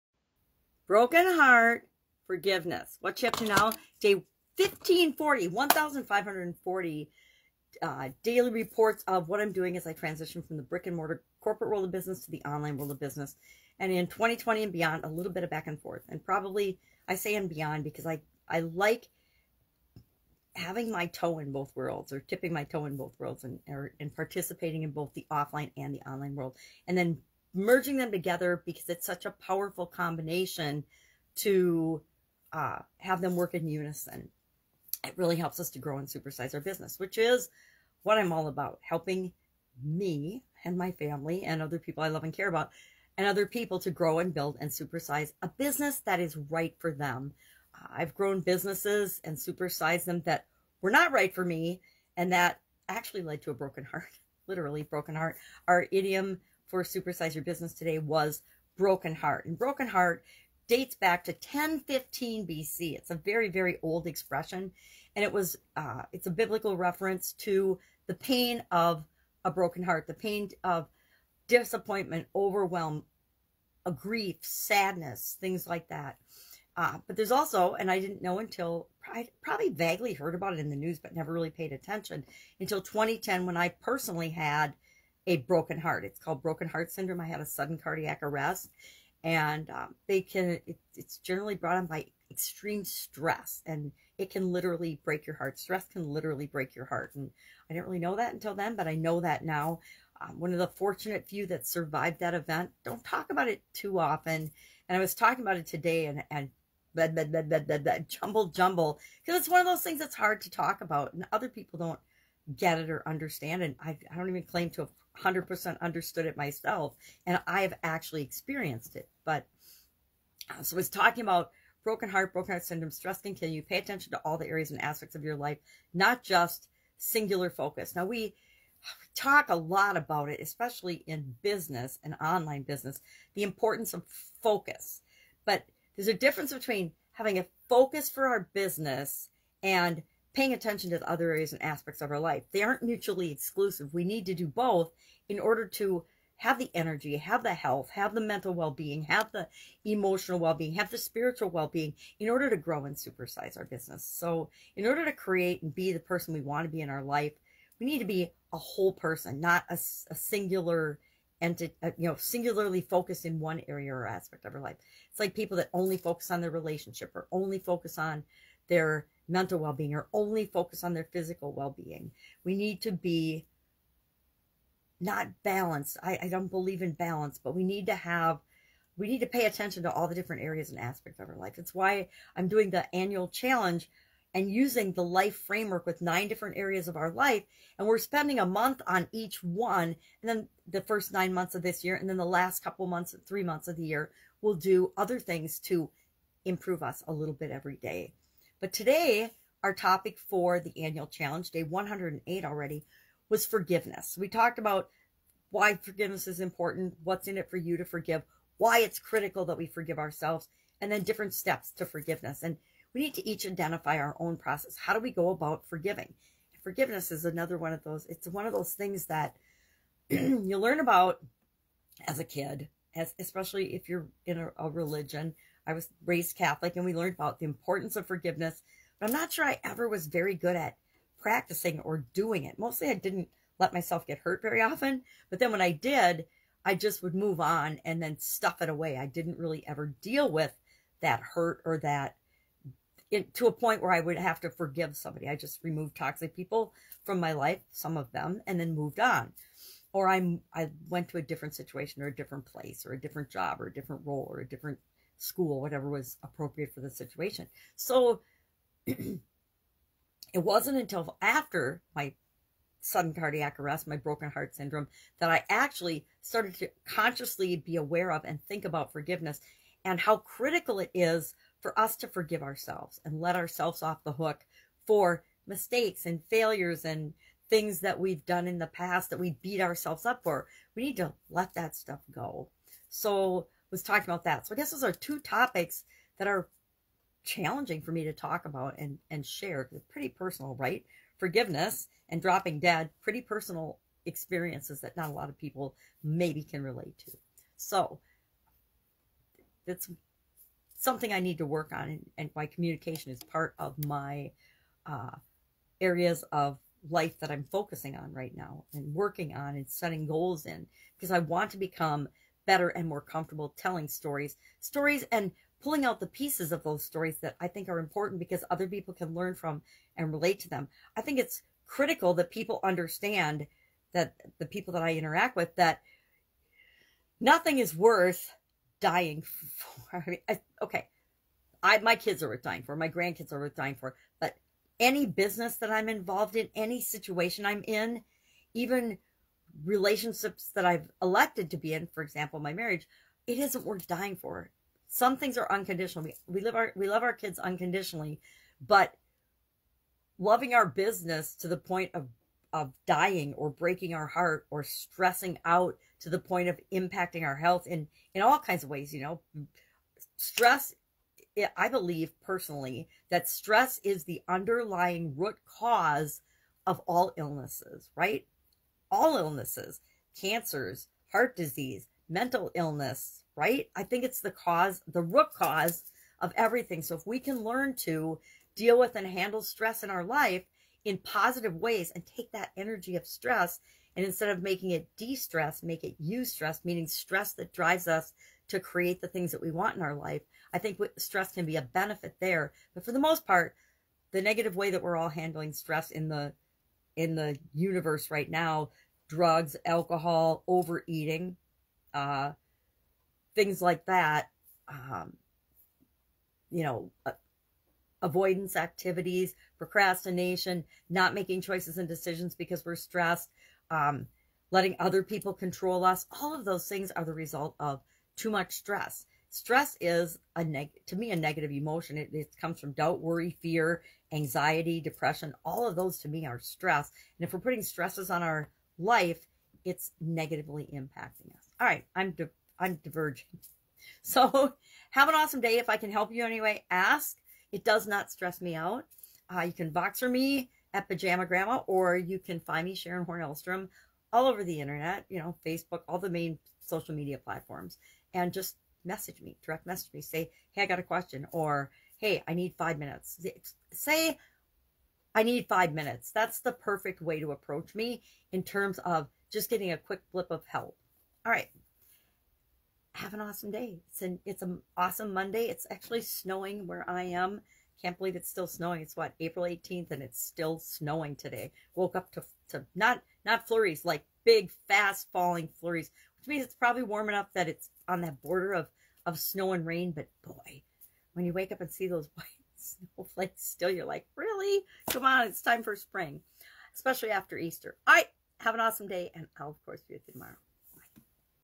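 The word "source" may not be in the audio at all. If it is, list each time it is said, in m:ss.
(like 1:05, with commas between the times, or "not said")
not said.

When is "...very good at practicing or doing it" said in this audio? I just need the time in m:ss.
3:50.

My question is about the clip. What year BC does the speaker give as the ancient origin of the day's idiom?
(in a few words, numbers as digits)
1015 BC.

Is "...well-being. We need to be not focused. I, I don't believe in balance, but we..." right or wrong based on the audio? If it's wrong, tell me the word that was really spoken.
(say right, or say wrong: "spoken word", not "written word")
wrong: "balanced", not "focused".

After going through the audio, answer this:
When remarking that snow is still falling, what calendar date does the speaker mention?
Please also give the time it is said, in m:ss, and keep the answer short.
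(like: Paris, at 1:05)
April 18, at 7:49.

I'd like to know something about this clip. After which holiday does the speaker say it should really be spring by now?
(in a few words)
Easter.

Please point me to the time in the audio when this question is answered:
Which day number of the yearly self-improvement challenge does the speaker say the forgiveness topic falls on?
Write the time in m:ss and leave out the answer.
3:21.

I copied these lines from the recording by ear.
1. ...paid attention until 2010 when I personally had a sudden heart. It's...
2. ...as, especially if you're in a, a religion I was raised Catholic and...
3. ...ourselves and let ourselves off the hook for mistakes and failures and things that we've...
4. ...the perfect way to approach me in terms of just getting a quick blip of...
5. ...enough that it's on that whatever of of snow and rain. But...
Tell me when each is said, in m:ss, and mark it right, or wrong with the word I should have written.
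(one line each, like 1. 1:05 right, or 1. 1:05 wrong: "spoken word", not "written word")
1. 1:21 wrong: "broken", not "sudden"
2. 3:42 right
3. 4:32 right
4. 7:36 right
5. 7:57 wrong: "border", not "whatever".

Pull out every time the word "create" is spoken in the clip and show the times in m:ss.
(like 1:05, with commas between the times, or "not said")
2:35, 6:28.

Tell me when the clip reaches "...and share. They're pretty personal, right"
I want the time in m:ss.
4:49.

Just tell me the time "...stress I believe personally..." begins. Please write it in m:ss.
6:00.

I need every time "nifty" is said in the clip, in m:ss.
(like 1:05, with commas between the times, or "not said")
not said.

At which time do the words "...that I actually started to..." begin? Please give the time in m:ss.
4:25.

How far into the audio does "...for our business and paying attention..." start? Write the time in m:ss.
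2:18.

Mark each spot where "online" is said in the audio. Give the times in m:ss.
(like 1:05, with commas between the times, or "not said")
0:12, 0:26, 2:12.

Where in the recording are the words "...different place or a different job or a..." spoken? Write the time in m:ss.
4:12.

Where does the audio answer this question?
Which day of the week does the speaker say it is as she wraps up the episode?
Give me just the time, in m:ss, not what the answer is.
7:45.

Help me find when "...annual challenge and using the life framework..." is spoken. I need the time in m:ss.
3:02.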